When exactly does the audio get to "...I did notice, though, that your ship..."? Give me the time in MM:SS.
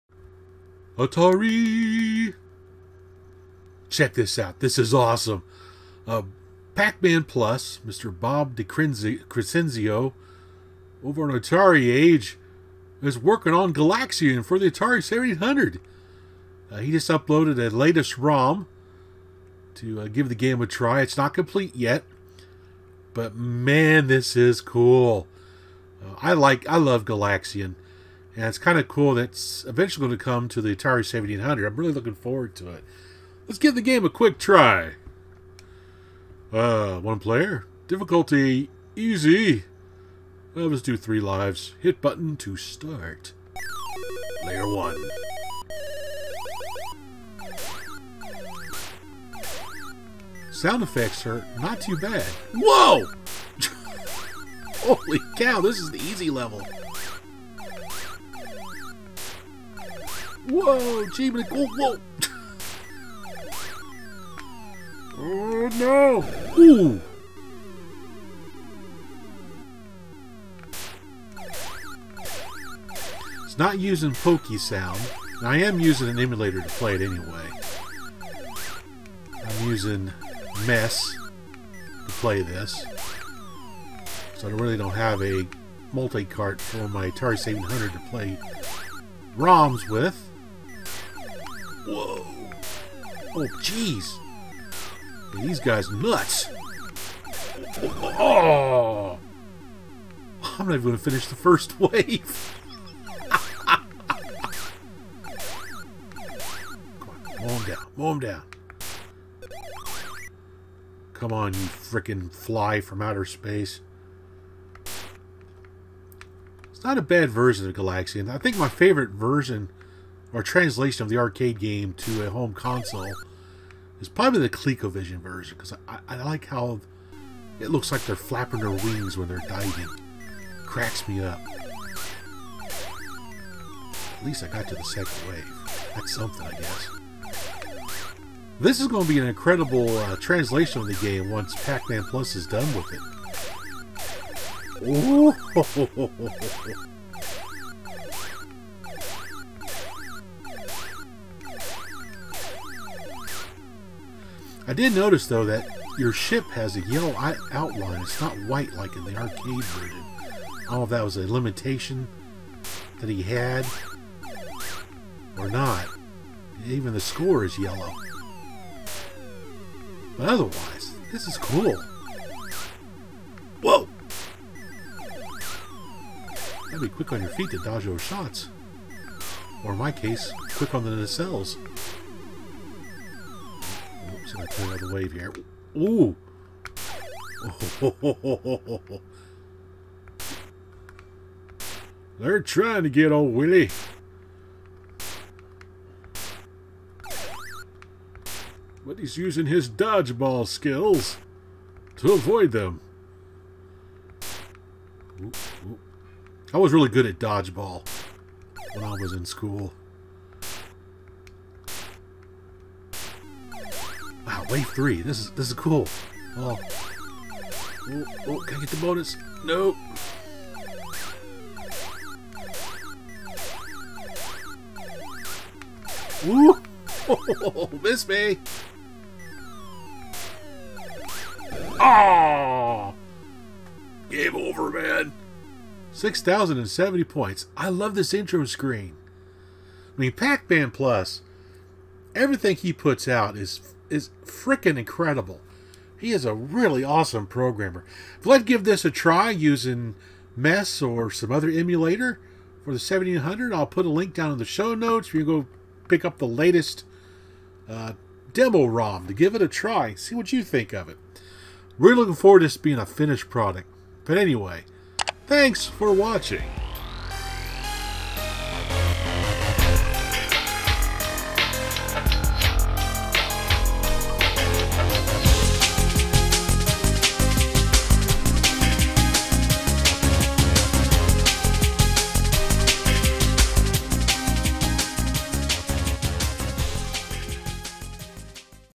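02:34.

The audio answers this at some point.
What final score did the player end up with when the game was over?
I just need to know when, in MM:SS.
03:55.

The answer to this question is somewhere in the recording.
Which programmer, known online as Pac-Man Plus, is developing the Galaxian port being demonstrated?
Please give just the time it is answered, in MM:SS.
00:08.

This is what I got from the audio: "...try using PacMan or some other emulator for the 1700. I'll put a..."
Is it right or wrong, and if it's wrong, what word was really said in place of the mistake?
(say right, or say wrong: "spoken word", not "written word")
wrong: "Mess", not "PacMan".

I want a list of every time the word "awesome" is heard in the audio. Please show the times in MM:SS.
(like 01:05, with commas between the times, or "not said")
00:04, 04:06.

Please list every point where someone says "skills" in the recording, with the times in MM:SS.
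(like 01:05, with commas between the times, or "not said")
03:20.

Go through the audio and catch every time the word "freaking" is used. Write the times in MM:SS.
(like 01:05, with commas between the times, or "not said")
01:51, 04:04.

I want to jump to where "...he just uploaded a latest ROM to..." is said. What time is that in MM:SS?
00:16.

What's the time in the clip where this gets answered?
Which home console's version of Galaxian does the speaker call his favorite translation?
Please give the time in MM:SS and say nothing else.
02:04.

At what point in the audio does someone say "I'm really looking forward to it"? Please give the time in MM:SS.
00:31.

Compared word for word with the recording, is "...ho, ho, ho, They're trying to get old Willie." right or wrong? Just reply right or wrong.
right.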